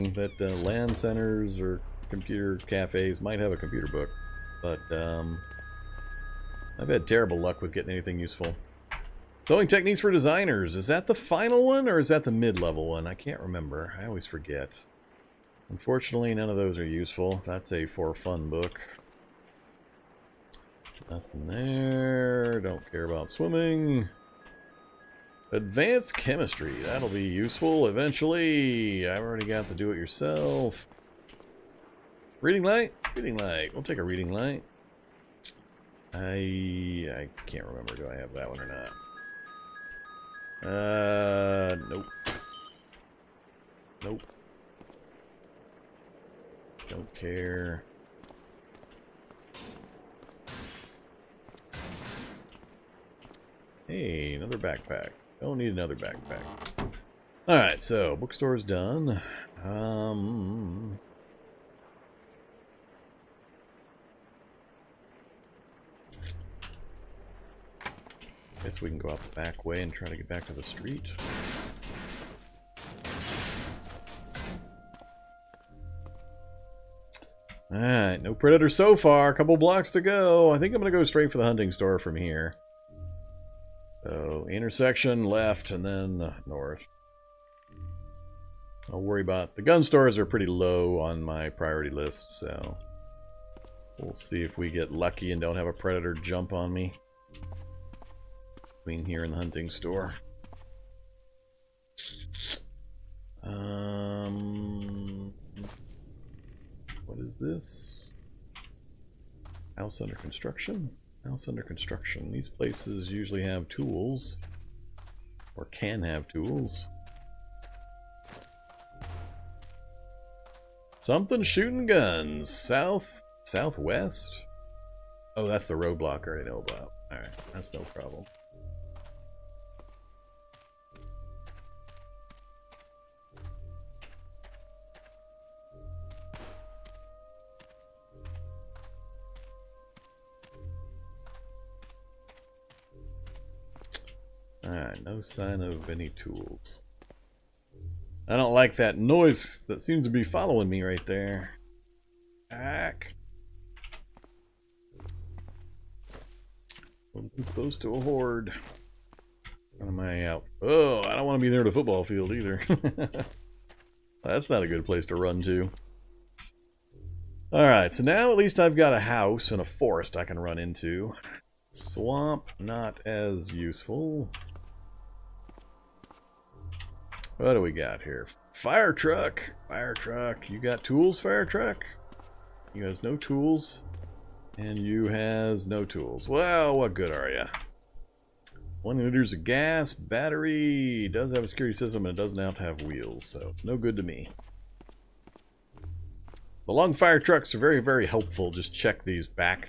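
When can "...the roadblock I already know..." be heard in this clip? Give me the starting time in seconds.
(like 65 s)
125 s.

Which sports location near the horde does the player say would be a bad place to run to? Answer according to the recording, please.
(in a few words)
Football field.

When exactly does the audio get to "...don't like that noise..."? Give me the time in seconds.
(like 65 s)
148 s.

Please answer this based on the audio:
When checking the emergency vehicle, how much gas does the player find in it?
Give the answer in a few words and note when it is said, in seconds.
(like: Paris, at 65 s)
1 liter, at 188 s.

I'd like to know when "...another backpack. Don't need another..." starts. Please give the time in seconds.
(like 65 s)
54 s.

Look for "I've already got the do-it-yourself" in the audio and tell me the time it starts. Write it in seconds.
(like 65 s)
29 s.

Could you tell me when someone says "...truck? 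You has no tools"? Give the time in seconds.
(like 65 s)
181 s.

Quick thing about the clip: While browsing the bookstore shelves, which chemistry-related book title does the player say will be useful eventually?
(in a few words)
Advanced chemistry.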